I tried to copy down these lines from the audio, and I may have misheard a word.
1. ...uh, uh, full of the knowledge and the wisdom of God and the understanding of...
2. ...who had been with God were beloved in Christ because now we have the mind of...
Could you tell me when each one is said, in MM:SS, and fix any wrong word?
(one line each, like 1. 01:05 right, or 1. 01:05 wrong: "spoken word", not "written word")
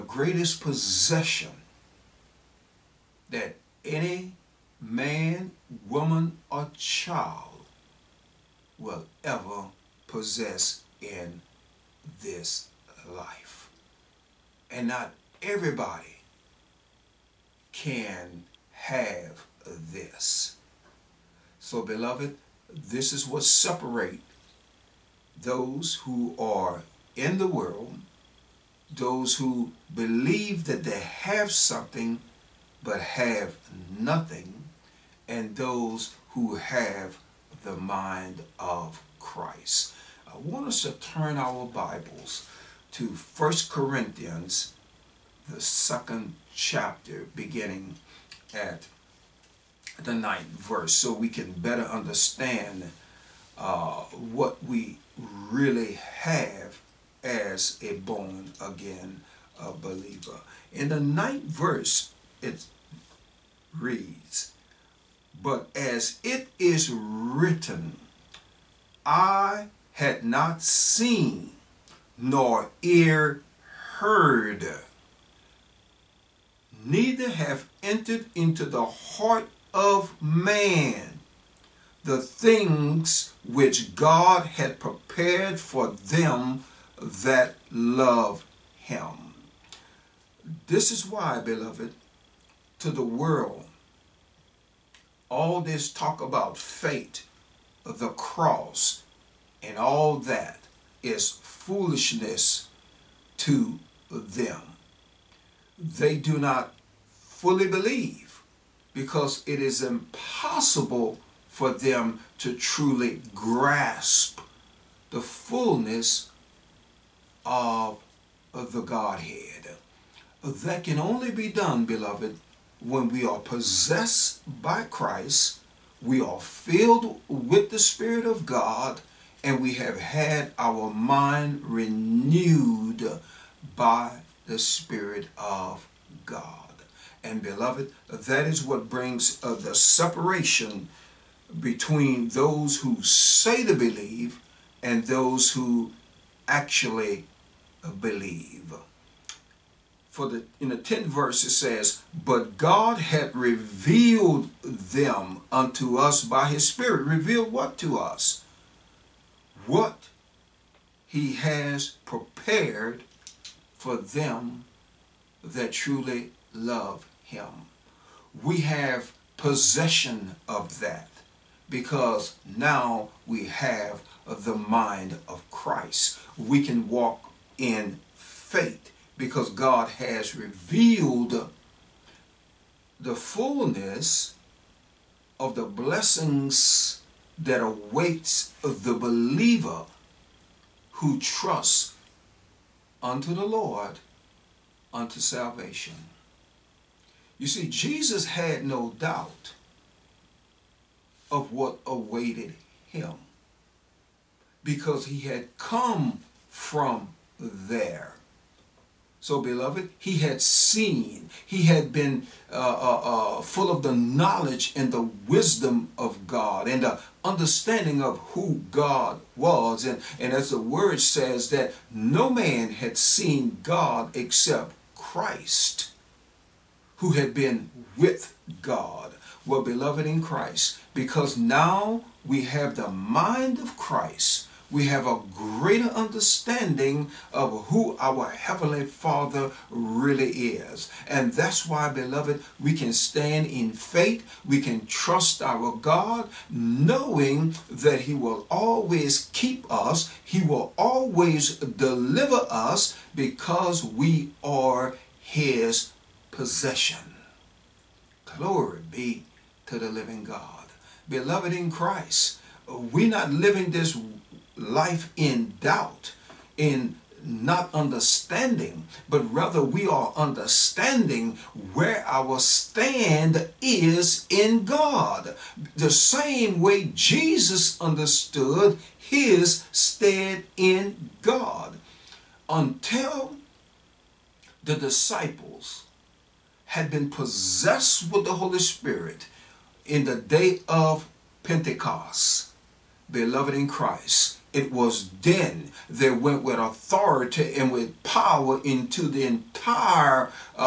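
1. 03:32 right
2. 03:46 right.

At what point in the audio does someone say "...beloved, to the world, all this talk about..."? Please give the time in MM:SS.
01:31.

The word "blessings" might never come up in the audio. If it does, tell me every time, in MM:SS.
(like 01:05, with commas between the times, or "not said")
03:05.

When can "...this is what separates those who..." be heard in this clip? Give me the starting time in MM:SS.
00:22.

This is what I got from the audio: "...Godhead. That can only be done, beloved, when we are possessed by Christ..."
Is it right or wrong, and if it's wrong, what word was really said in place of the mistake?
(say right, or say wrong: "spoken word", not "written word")
right.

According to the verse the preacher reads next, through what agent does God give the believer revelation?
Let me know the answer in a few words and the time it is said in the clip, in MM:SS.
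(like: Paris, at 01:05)
his Spirit, at 02:36.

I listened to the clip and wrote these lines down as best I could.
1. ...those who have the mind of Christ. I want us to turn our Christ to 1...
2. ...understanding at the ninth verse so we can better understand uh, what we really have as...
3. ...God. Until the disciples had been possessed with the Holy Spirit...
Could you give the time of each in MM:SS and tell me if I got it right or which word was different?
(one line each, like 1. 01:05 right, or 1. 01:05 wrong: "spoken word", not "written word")
1. 00:35 wrong: "Bibles", not "Christ"
2. 00:47 wrong: "beginning", not "understanding"
3. 04:41 right.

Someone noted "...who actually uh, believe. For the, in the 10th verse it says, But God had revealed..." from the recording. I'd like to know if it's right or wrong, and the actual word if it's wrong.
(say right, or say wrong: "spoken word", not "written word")
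right.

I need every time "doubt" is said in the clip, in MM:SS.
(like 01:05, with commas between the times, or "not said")
03:18, 04:25.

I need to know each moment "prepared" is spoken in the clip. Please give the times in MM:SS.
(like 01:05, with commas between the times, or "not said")
01:24, 02:42.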